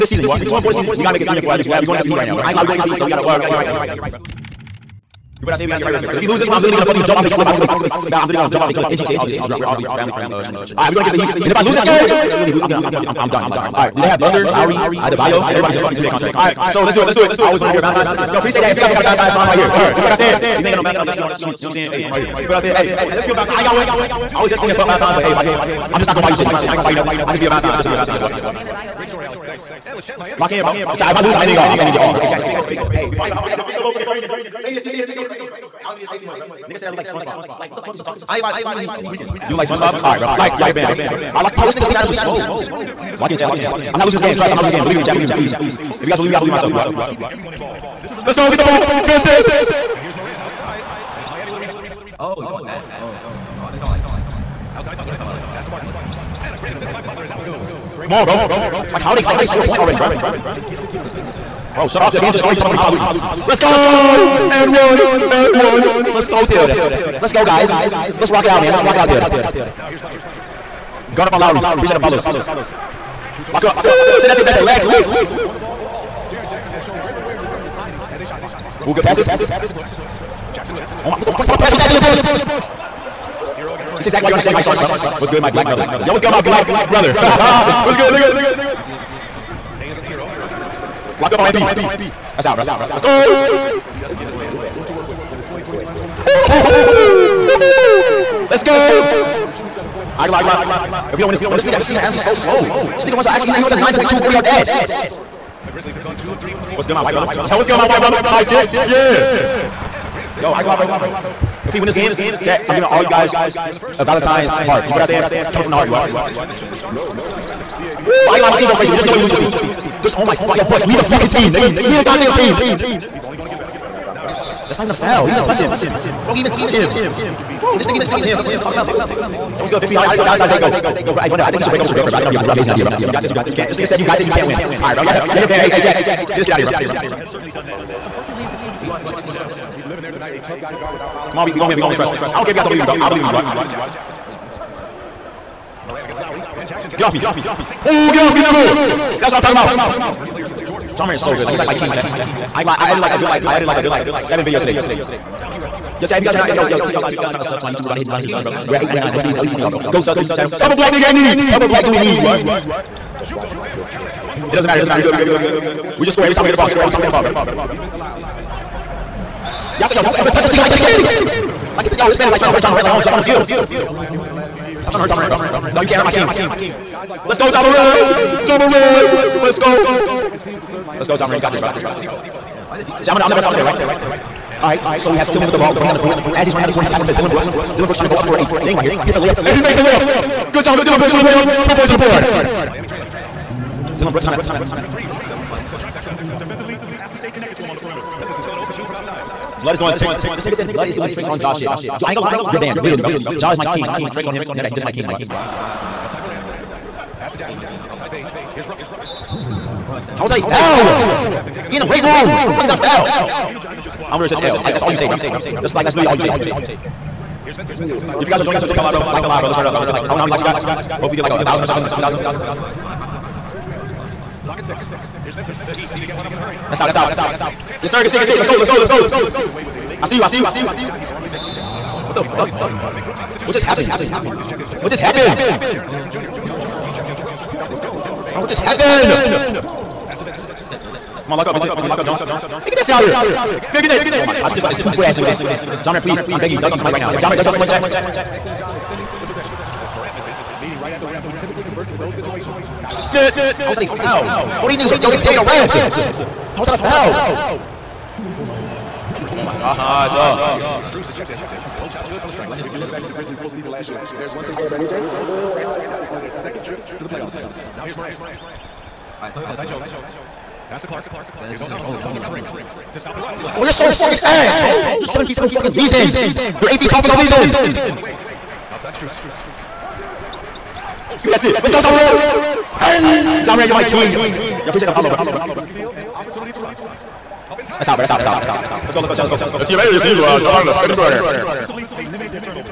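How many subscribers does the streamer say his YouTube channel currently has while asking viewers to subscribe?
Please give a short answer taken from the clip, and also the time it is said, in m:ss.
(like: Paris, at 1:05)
899, at 2:38.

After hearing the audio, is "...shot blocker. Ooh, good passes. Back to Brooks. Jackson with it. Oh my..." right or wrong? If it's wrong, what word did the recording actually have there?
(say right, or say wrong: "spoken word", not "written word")
right.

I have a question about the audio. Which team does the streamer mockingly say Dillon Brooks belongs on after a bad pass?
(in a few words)
Shanghai Sharks.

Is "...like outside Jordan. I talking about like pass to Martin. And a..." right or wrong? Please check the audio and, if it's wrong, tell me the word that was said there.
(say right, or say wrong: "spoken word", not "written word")
wrong: "Butler", not "Jordan".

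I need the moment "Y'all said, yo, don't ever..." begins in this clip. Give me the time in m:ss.
2:49.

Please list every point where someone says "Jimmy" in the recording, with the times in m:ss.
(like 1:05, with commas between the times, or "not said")
2:16, 2:29.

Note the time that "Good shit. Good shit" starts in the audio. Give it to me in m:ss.
3:48.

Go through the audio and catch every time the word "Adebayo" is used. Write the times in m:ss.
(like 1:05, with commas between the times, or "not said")
0:15, 0:28.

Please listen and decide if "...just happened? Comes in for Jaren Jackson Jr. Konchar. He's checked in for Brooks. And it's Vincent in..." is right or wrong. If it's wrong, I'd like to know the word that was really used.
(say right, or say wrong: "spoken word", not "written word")
wrong: "Jones", not "Vincent".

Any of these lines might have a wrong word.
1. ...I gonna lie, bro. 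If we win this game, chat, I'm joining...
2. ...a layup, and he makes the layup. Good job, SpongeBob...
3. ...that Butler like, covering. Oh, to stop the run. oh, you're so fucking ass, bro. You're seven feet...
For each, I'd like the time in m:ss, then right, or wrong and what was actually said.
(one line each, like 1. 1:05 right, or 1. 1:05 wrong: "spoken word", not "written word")
1. 1:50 wrong: "giving", not "joining"
2. 3:09 wrong: "Dillon", not "SpongeBob"
3. 4:31 right.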